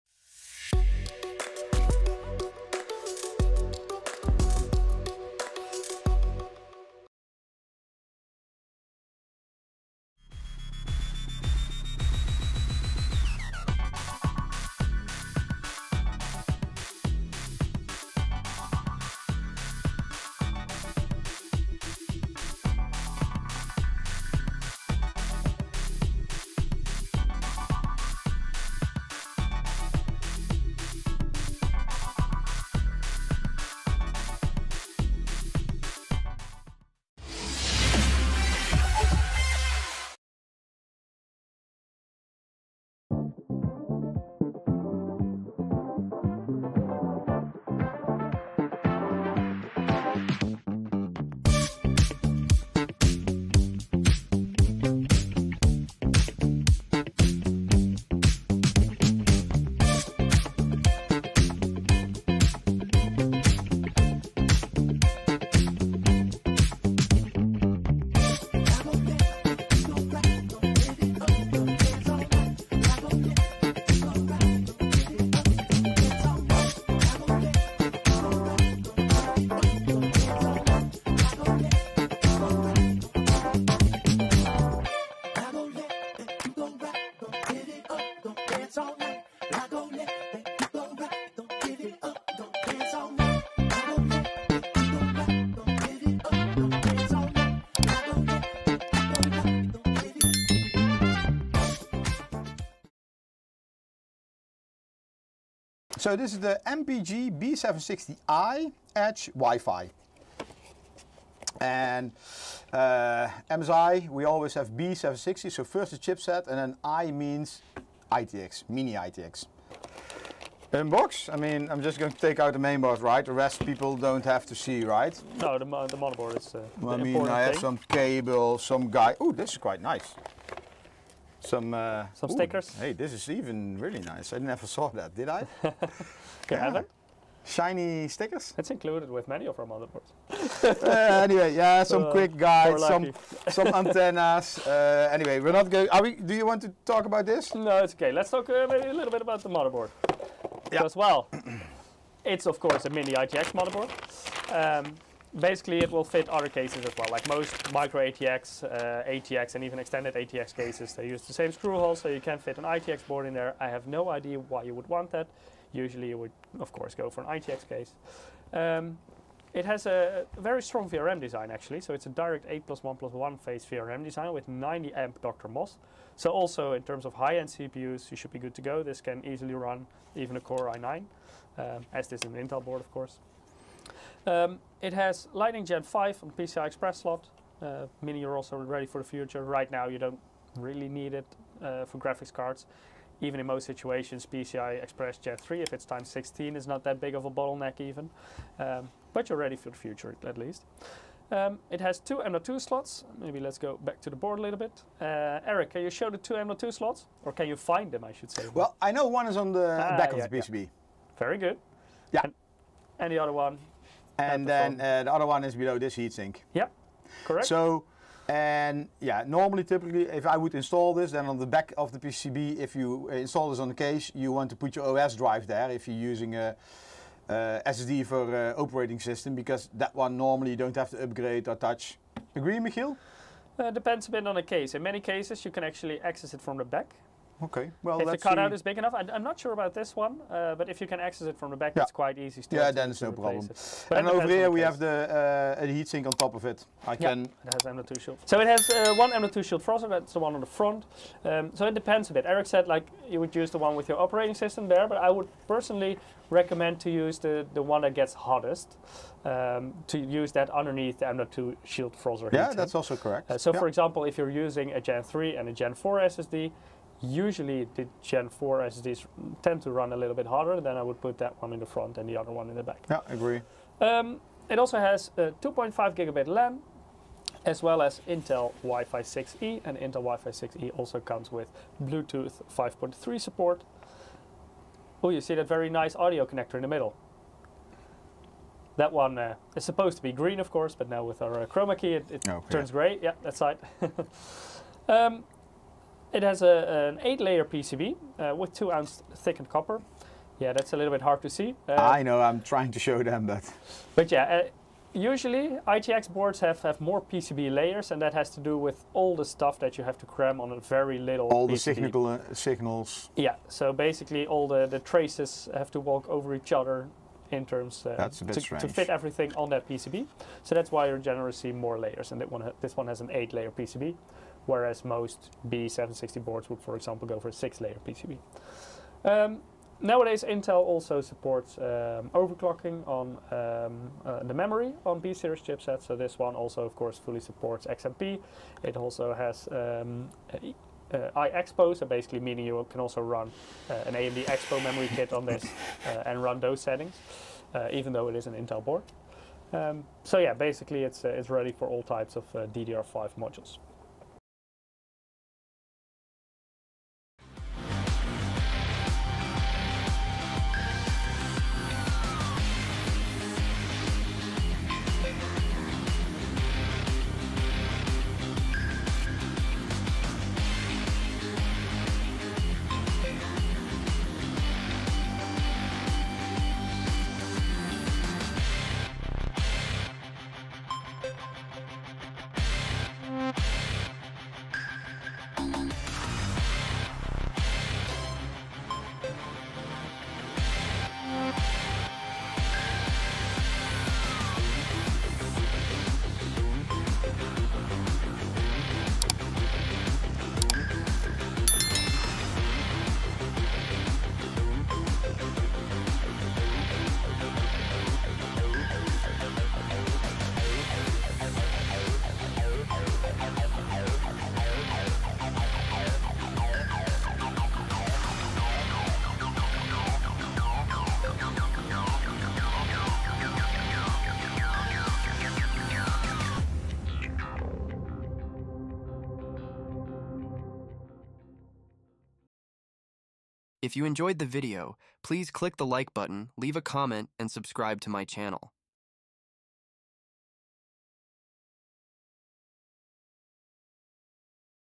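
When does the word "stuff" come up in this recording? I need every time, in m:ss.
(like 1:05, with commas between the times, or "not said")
5:09.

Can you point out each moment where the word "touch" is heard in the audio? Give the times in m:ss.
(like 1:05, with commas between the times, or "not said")
3:51.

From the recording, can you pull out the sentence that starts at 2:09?
Oh, this is quite nice some uh, some stickers.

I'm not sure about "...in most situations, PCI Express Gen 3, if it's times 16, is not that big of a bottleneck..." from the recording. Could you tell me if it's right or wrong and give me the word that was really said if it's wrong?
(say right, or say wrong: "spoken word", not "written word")
right.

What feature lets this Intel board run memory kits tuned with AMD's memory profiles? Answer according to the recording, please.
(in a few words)
iExpo.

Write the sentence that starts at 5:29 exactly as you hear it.
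Um, nowadays, Intel also supports um, overclocking on um, uh, the memory on B-series chipsets.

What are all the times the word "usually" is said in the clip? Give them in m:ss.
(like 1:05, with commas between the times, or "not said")
2:45, 4:27, 5:04.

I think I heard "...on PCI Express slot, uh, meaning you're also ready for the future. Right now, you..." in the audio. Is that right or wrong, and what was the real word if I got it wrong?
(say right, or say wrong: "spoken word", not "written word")
right.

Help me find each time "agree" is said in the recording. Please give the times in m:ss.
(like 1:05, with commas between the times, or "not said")
3:52, 4:33.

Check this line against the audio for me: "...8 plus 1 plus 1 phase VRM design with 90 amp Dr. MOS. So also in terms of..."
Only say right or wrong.
right.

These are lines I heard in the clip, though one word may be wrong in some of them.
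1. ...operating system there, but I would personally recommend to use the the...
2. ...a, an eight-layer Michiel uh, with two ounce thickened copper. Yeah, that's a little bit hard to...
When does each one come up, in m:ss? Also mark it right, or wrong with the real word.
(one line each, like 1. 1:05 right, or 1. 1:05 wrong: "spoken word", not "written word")
1. 4:13 right
2. 4:56 wrong: "PCB", not "Michiel".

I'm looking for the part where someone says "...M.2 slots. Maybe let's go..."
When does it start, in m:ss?
3:22.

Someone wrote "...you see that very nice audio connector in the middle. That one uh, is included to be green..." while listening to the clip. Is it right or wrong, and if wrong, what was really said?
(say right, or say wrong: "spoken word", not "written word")
wrong: "supposed", not "included".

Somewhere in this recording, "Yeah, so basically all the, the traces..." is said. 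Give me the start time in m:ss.
5:13.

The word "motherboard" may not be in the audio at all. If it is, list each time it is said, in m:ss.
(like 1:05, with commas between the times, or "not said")
2:05, 2:19, 2:29, 2:33.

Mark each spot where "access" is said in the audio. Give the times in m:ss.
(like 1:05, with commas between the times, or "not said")
3:56, 4:00.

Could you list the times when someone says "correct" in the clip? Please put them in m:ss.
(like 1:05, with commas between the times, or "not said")
3:37, 4:22.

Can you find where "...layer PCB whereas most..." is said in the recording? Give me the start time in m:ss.
5:23.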